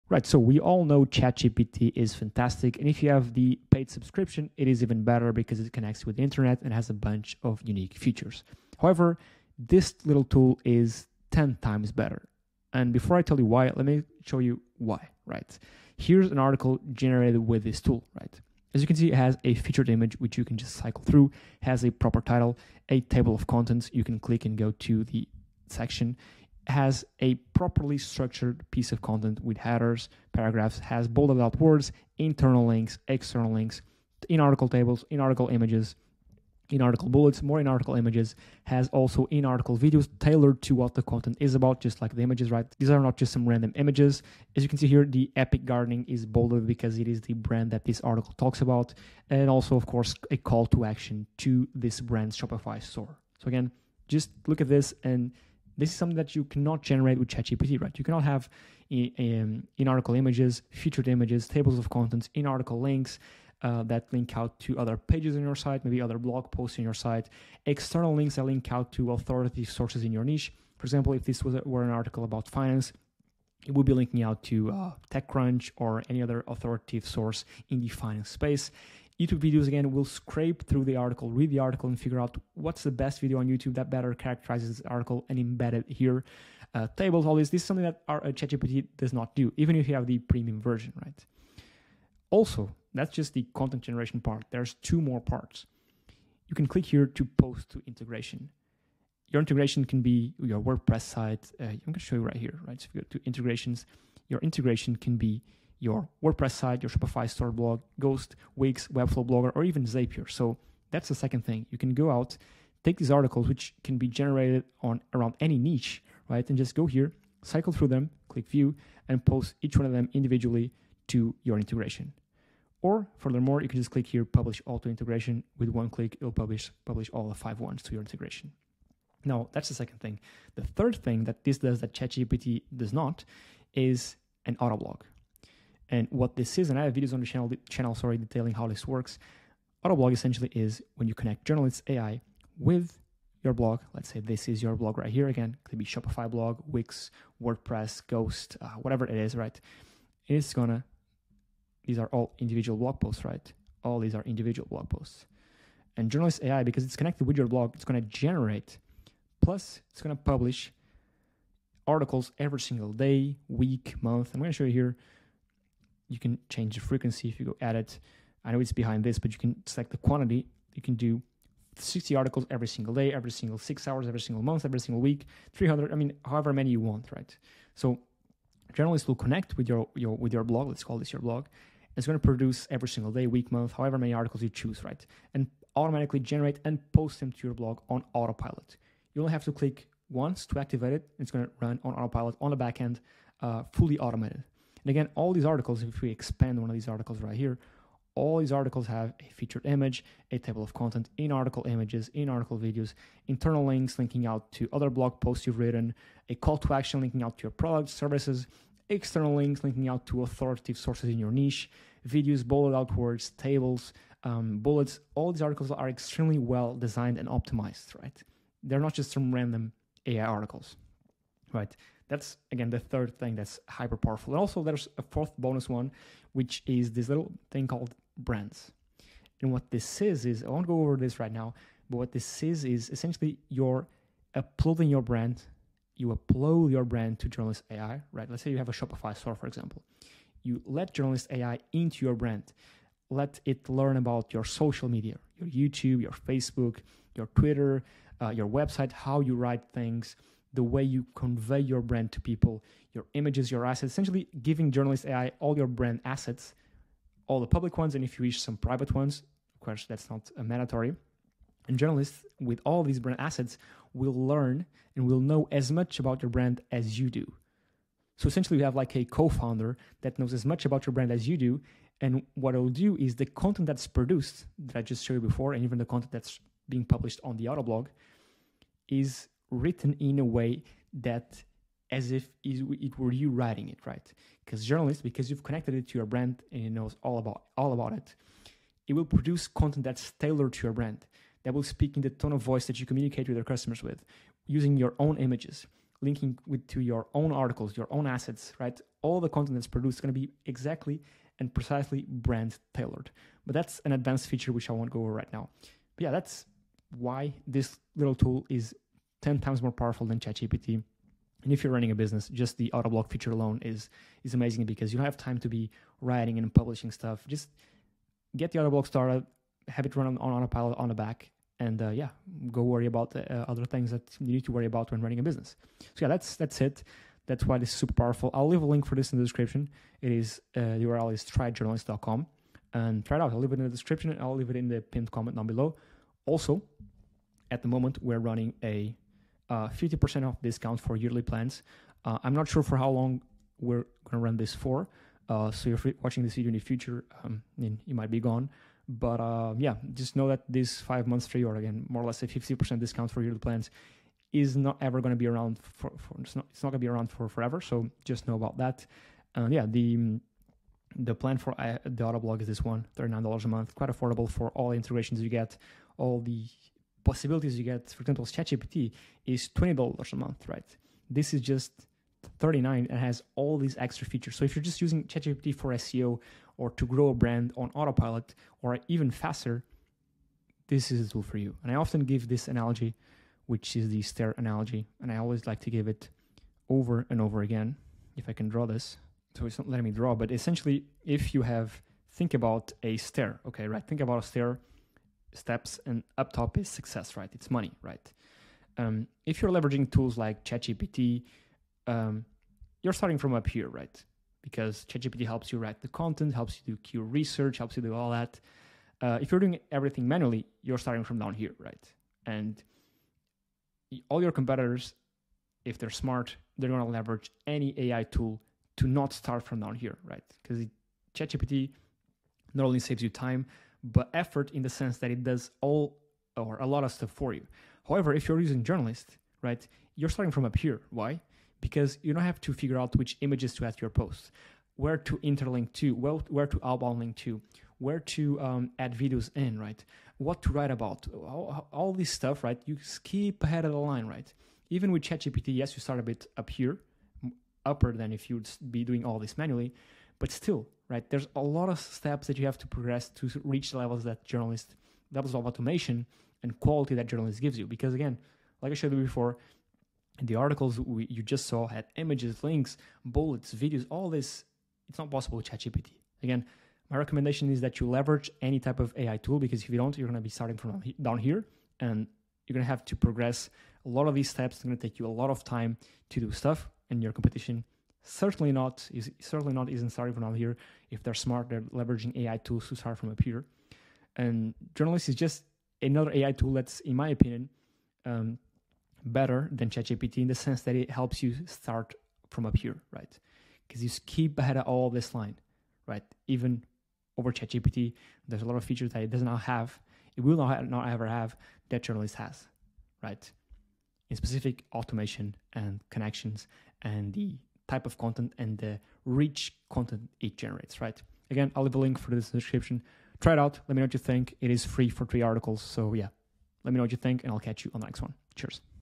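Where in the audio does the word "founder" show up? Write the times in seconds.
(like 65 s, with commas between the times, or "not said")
269 s.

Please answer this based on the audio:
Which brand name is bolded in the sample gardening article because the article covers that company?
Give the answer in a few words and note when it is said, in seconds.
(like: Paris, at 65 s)
Epic Gardening, at 45 s.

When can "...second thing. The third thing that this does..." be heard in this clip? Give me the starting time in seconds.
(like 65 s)
129 s.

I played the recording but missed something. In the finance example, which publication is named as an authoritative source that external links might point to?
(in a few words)
TechCrunch.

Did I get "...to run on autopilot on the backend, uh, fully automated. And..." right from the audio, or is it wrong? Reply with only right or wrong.
right.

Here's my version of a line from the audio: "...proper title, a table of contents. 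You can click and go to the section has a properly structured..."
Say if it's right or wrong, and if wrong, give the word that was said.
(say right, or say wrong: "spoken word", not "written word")
right.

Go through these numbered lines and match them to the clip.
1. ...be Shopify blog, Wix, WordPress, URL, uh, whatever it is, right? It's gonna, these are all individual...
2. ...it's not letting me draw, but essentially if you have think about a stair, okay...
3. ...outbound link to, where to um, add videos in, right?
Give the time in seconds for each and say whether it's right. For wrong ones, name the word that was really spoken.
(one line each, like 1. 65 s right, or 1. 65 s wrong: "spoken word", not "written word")
1. 145 s wrong: "Ghost", not "URL"
2. 389 s right
3. 436 s right.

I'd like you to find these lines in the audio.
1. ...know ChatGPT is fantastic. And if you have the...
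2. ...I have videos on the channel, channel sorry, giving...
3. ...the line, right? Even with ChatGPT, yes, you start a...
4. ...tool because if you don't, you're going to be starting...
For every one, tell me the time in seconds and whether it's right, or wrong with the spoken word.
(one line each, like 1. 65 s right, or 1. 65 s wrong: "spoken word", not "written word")
1. 0 s right
2. 136 s wrong: "detailing", not "giving"
3. 443 s right
4. 469 s right.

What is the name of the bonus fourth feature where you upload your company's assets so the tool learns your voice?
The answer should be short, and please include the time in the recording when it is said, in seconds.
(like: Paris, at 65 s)
brands, at 228 s.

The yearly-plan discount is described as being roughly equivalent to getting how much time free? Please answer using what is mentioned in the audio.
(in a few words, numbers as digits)
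5 months.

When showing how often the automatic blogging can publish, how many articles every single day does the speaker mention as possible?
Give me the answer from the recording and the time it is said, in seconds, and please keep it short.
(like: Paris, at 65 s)
60, at 171 s.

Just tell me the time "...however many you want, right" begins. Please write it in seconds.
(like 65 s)
176 s.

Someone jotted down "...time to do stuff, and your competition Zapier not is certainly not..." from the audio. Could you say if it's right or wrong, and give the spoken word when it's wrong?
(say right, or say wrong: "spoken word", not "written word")
wrong: "Certainly", not "Zapier".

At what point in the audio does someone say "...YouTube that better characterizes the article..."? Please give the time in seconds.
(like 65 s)
83 s.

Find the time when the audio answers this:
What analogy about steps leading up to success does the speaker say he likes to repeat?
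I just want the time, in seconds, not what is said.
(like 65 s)
384 s.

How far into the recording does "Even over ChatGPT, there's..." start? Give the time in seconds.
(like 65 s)
496 s.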